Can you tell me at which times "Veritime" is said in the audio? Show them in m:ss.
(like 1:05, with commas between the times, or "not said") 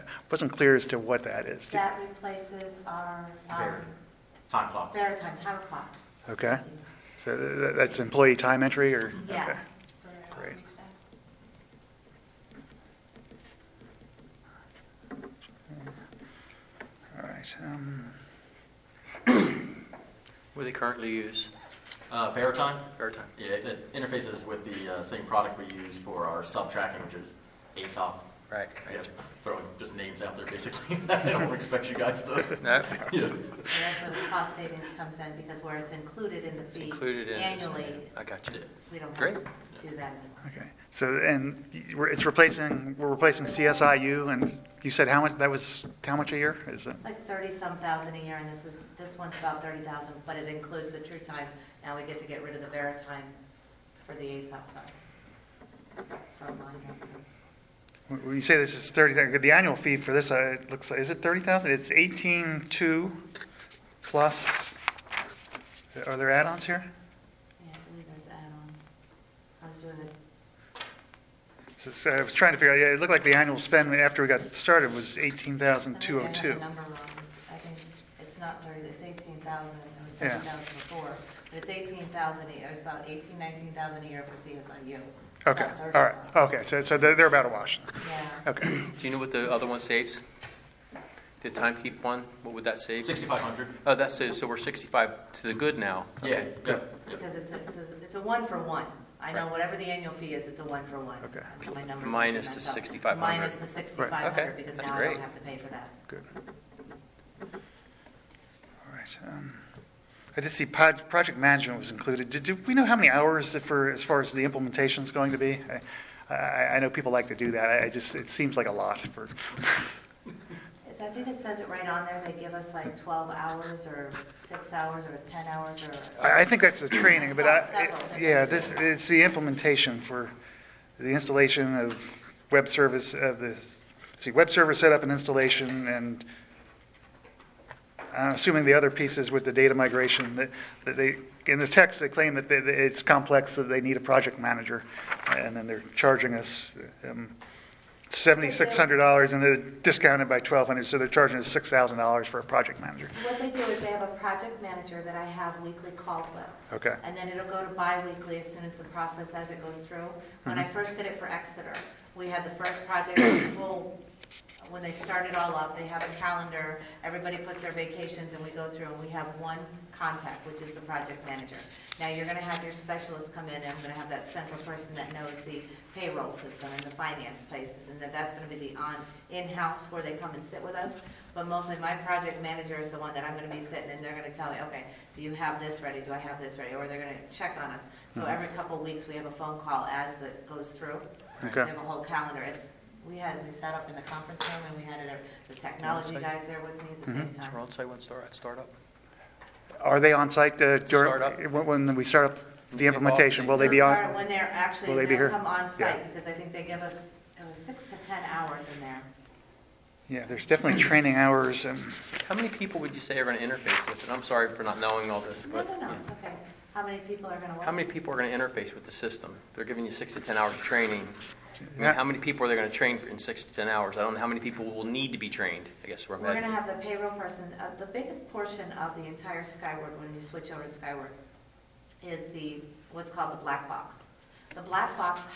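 0:04, 0:22, 0:52.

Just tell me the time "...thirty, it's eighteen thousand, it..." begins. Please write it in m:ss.
1:18.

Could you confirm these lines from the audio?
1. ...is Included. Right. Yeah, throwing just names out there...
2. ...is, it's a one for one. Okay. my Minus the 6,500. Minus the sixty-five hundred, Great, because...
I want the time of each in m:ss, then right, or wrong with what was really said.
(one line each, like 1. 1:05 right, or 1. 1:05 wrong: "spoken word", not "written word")
1. 0:27 wrong: "Aesop", not "Included"
2. 1:40 wrong: "Okay", not "Great".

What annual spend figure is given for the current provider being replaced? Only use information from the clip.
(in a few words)
$18,202.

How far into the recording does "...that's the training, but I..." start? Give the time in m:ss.
2:06.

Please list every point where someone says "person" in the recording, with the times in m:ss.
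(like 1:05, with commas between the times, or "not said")
2:54, 3:47.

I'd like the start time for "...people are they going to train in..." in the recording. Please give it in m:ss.
3:42.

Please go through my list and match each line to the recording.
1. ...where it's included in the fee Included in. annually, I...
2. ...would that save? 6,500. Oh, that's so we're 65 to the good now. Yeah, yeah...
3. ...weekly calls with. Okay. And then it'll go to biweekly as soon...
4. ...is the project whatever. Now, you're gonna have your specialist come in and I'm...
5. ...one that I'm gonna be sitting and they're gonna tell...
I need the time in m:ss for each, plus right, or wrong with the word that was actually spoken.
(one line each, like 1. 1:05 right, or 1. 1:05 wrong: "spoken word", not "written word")
1. 0:35 right
2. 1:32 right
3. 2:35 right
4. 2:50 wrong: "manager", not "whatever"
5. 3:02 right.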